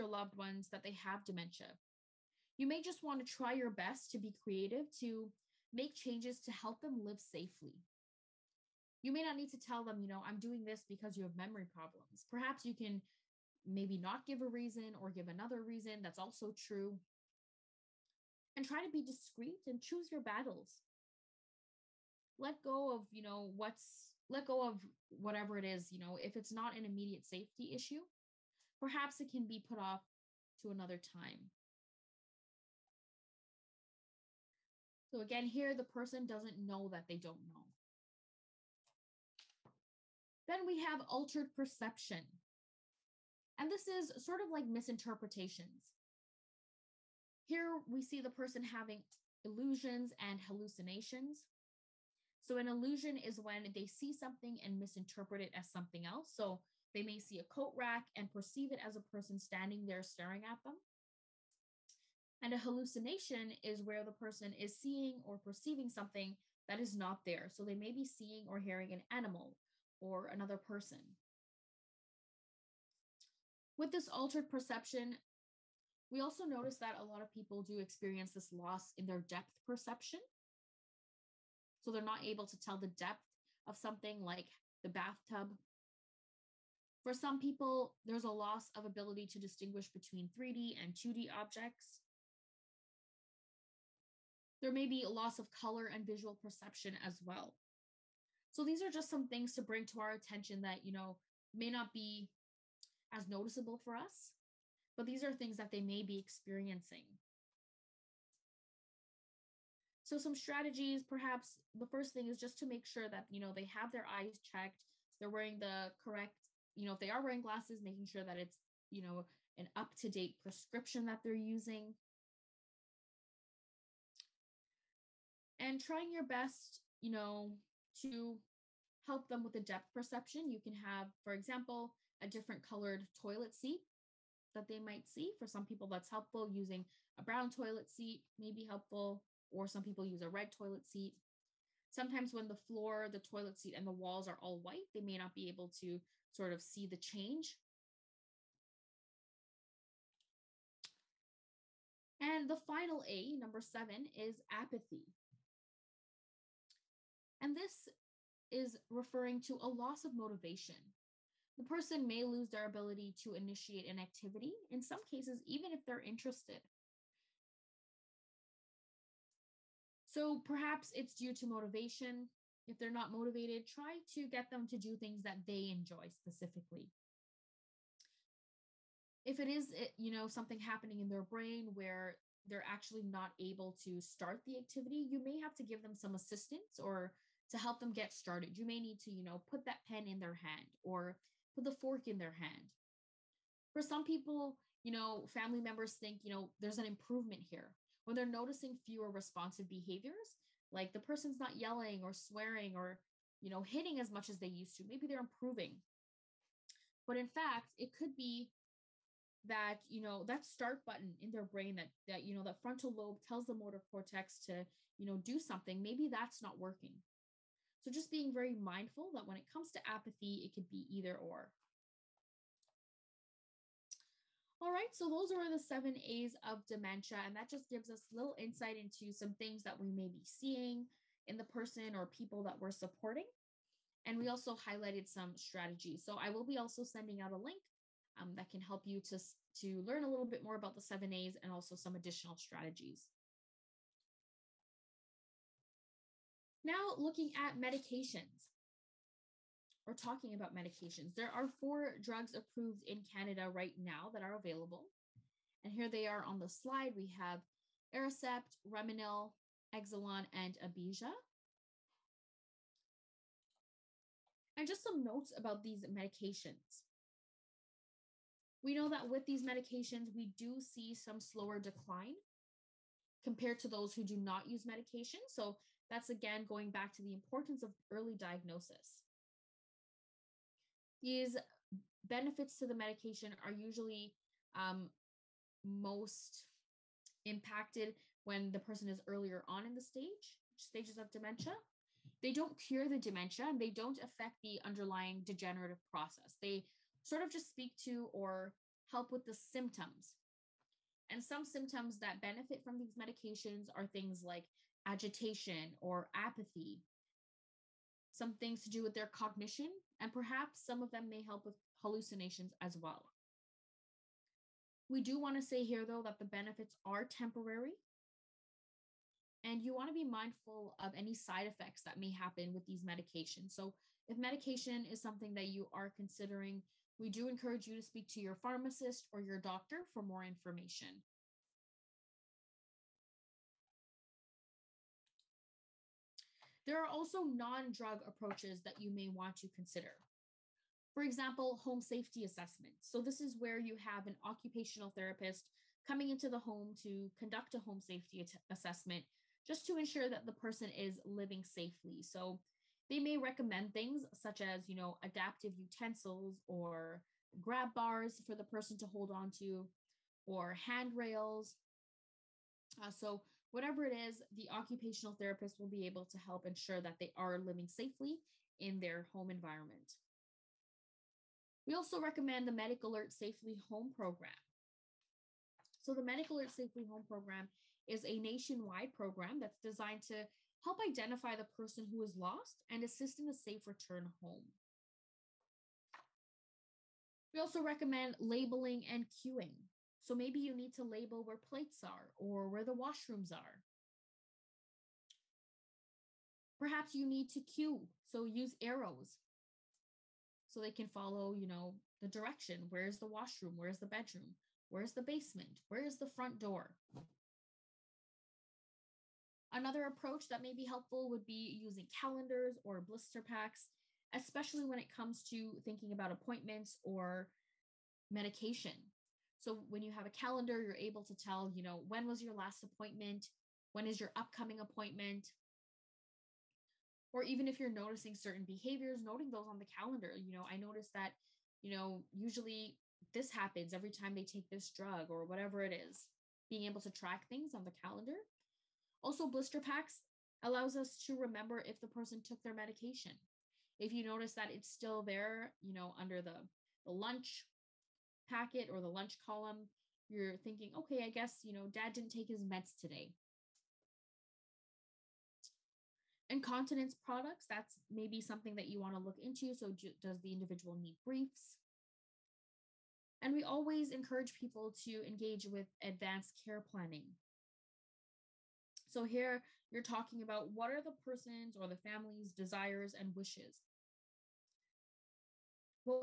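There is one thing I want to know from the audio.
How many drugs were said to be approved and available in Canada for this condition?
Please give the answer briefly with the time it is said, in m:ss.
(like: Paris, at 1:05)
4, at 4:11.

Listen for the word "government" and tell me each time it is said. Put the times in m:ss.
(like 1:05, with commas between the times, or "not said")
not said.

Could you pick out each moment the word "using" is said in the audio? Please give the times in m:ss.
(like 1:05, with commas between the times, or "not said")
2:01, 2:16, 6:51.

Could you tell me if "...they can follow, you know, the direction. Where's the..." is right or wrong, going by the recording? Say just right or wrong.
right.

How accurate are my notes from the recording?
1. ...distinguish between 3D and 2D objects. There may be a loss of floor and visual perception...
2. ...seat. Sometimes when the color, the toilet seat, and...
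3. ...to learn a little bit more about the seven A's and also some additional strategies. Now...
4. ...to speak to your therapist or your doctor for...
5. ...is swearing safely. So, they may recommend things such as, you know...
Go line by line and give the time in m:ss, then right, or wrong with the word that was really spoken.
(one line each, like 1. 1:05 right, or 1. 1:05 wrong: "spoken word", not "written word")
1. 1:29 wrong: "color", not "floor"
2. 2:20 wrong: "floor", not "color"
3. 3:59 right
4. 5:27 wrong: "pharmacist", not "therapist"
5. 5:50 wrong: "living", not "swearing".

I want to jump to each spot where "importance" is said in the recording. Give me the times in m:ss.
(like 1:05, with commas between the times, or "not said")
4:37.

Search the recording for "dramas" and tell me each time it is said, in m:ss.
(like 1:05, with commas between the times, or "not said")
not said.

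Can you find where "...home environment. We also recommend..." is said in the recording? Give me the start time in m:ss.
6:09.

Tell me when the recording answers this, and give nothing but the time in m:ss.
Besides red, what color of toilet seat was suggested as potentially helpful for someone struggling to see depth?
2:17.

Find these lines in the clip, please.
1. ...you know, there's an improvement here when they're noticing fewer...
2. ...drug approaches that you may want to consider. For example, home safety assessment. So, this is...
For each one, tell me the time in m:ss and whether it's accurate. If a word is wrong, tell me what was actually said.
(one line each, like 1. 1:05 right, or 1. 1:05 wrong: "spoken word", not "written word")
1. 3:16 right
2. 5:37 right.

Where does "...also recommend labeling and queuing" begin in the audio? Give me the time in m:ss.
6:27.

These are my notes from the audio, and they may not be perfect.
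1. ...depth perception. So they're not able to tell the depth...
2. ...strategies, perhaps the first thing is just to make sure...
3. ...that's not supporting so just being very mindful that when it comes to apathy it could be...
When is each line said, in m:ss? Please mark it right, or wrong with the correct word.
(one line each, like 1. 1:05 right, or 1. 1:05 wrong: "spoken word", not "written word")
1. 1:19 right
2. 1:50 right
3. 3:36 wrong: "working", not "supporting".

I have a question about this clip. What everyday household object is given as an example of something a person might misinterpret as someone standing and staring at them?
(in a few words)
coat rack.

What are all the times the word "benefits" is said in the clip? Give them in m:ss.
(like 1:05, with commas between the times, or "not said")
4:42, 5:02, 5:16.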